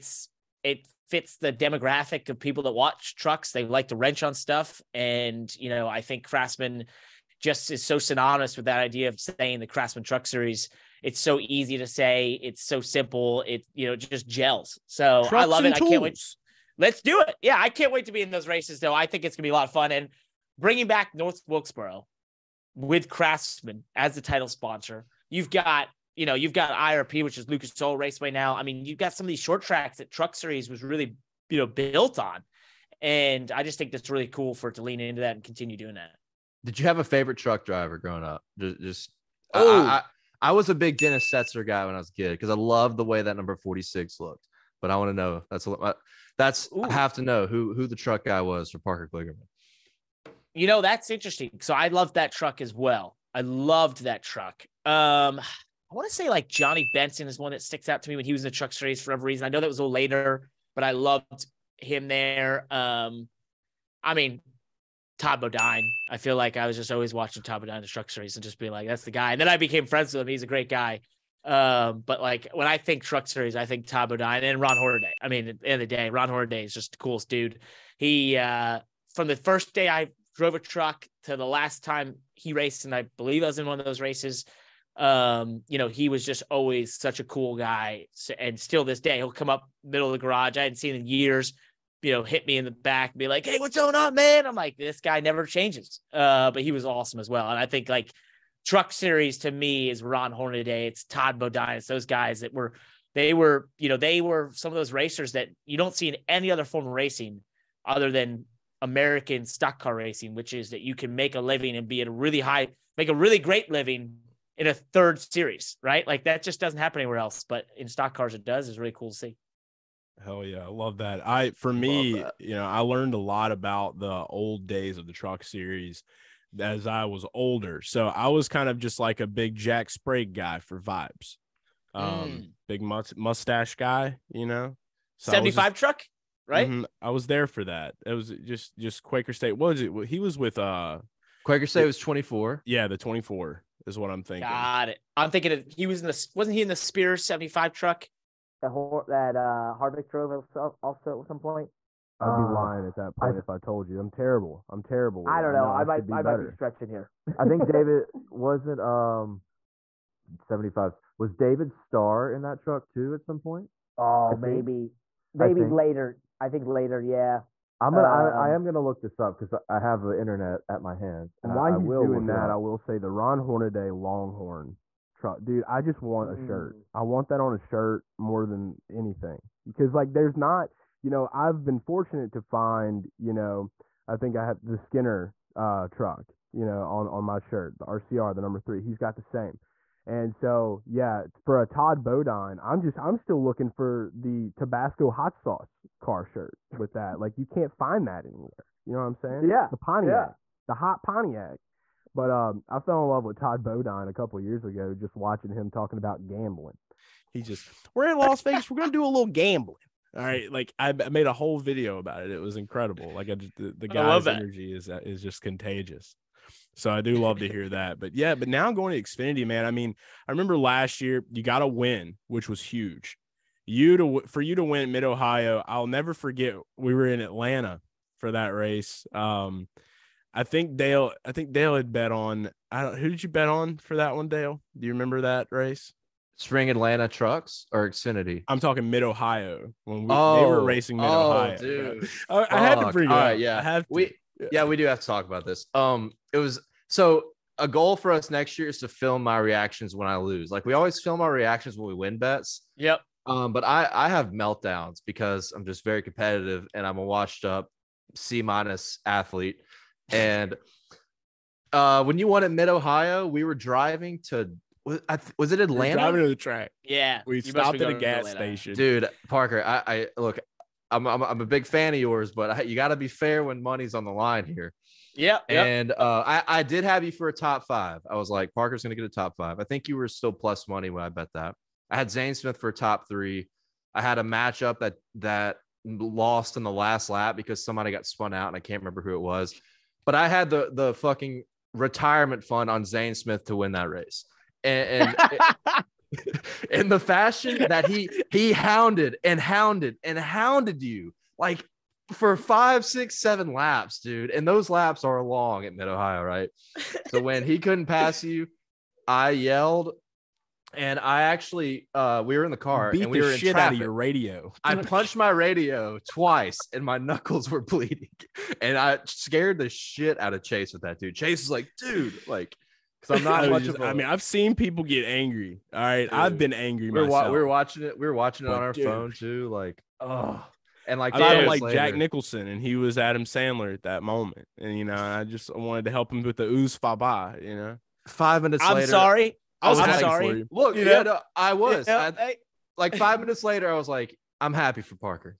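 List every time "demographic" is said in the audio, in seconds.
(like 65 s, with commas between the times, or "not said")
1 s.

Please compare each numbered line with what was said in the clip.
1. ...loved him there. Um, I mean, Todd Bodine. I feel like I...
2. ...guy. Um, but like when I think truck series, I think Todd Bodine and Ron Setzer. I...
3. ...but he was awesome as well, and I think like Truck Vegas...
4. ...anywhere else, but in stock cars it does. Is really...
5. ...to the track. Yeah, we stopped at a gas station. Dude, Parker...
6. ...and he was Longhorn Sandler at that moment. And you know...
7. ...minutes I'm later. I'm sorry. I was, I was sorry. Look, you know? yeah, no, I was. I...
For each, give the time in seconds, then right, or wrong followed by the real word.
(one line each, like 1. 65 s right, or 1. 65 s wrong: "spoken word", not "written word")
1. 60 s right
2. 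70 s wrong: "Hornaday", not "Setzer"
3. 96 s wrong: "Series", not "Vegas"
4. 117 s right
5. 266 s right
6. 332 s wrong: "Adam", not "Longhorn"
7. 338 s right.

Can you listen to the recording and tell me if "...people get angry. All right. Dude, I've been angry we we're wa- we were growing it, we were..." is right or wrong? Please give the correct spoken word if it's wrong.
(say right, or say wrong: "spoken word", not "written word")
wrong: "watching", not "growing".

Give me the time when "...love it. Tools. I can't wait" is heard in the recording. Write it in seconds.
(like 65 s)
15 s.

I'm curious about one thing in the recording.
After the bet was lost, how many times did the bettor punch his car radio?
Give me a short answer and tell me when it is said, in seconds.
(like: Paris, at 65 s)
2, at 316 s.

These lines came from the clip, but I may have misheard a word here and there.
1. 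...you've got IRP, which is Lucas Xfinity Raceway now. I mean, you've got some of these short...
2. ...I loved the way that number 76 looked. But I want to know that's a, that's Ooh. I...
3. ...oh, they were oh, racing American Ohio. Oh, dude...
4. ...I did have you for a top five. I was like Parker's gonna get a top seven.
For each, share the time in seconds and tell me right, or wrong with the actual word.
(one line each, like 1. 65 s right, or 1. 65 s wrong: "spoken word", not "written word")
1. 26 s wrong: "Oil", not "Xfinity"
2. 42 s wrong: "46", not "76"
3. 240 s wrong: "Mid", not "American"
4. 276 s wrong: "five", not "seven".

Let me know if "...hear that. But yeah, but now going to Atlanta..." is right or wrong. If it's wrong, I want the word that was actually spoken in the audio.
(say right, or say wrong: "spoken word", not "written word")
wrong: "Xfinity", not "Atlanta".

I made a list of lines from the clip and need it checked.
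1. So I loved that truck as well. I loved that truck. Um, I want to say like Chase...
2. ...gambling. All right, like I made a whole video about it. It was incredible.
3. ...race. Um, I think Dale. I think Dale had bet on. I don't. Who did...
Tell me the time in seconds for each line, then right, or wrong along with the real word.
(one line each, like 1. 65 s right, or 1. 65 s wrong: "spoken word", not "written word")
1. 51 s wrong: "Johnny", not "Chase"
2. 209 s right
3. 228 s right.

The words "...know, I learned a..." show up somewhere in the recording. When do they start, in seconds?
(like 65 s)
122 s.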